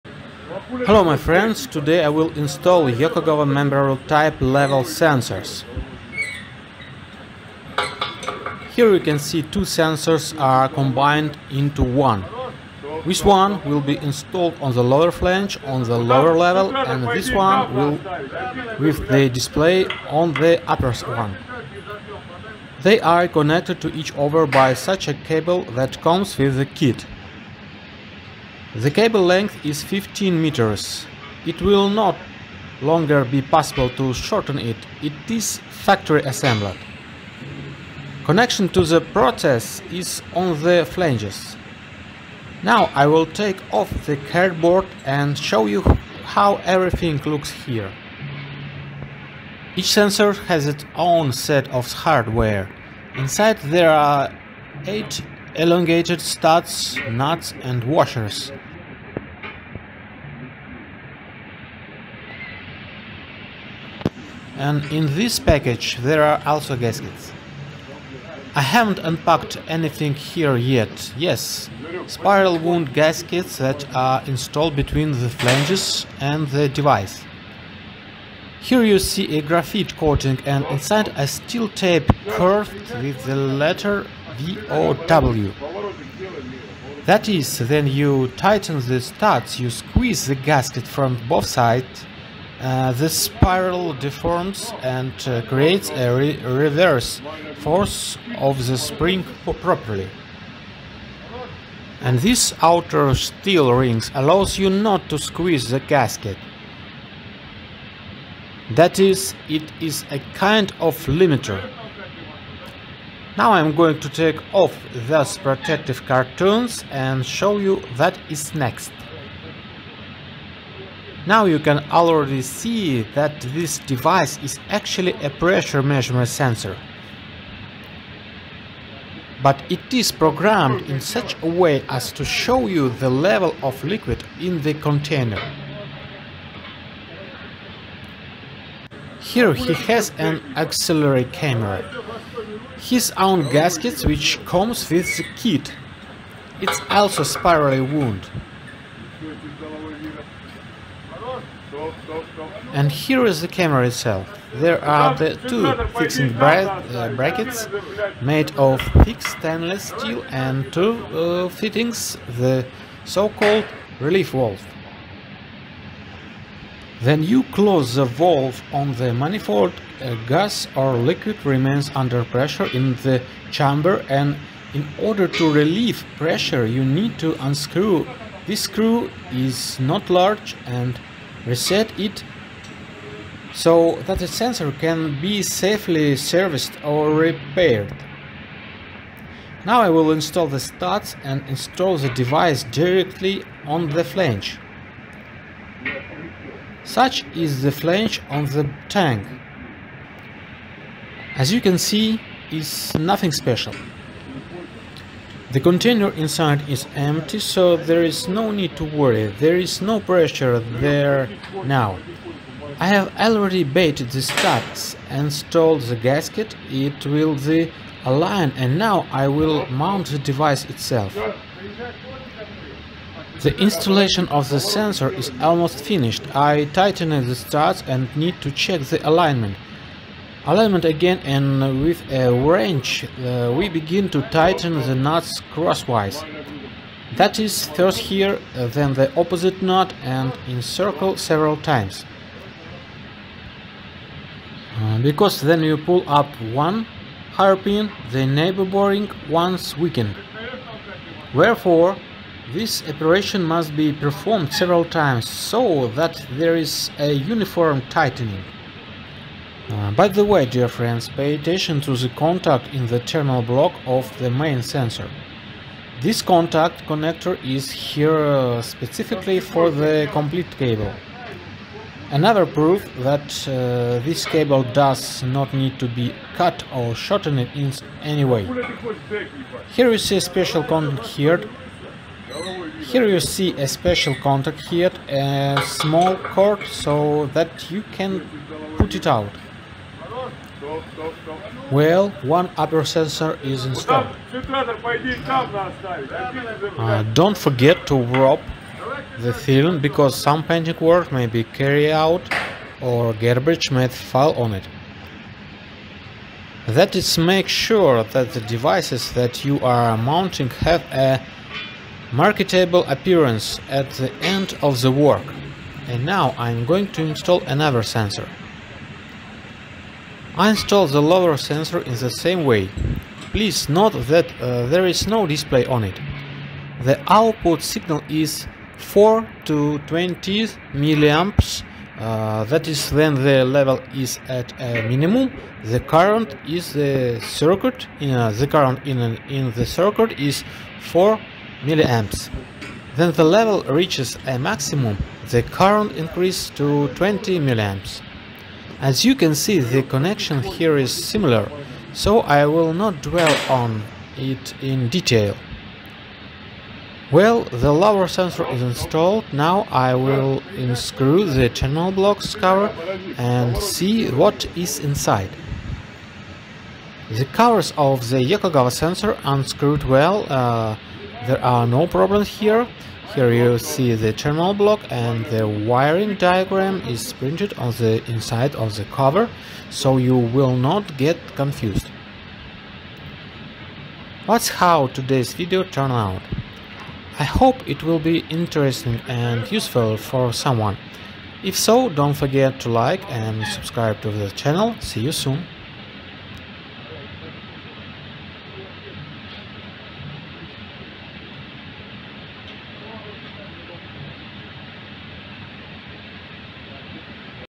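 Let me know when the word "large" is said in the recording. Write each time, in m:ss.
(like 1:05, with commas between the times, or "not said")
3:00.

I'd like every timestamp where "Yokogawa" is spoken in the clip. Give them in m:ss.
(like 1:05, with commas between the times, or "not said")
0:02, 6:08.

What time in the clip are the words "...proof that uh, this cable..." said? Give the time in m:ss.
4:32.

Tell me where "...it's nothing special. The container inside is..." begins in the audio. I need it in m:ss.
3:22.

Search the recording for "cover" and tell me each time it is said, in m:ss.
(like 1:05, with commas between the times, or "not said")
6:02, 6:07, 6:18.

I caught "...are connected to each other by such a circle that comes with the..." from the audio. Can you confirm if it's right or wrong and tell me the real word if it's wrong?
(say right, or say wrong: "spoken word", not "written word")
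wrong: "cable", not "circle".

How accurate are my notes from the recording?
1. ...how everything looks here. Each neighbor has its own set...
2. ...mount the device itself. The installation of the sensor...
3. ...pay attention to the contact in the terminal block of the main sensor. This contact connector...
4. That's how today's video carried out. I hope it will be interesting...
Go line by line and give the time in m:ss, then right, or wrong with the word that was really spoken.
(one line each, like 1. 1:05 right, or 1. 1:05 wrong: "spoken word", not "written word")
1. 0:46 wrong: "sensor", not "neighbor"
2. 3:39 right
3. 4:21 right
4. 6:24 wrong: "turned", not "carried".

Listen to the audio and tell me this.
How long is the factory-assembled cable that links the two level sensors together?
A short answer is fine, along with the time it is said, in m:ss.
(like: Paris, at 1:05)
15 meters, at 0:29.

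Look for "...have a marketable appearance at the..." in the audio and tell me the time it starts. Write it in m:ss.
5:10.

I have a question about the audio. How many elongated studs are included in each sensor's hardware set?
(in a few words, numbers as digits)
8.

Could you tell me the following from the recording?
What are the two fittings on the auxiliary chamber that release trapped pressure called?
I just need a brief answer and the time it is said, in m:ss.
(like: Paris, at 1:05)
Relief valve, at 2:43.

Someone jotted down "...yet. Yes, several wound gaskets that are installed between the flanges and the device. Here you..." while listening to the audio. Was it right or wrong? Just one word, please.
wrong.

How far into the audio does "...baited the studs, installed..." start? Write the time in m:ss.
3:33.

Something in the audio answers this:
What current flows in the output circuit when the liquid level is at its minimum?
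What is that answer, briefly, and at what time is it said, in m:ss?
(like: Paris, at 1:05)
4 milliamps, at 5:40.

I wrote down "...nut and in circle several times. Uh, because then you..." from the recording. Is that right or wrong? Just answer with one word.
right.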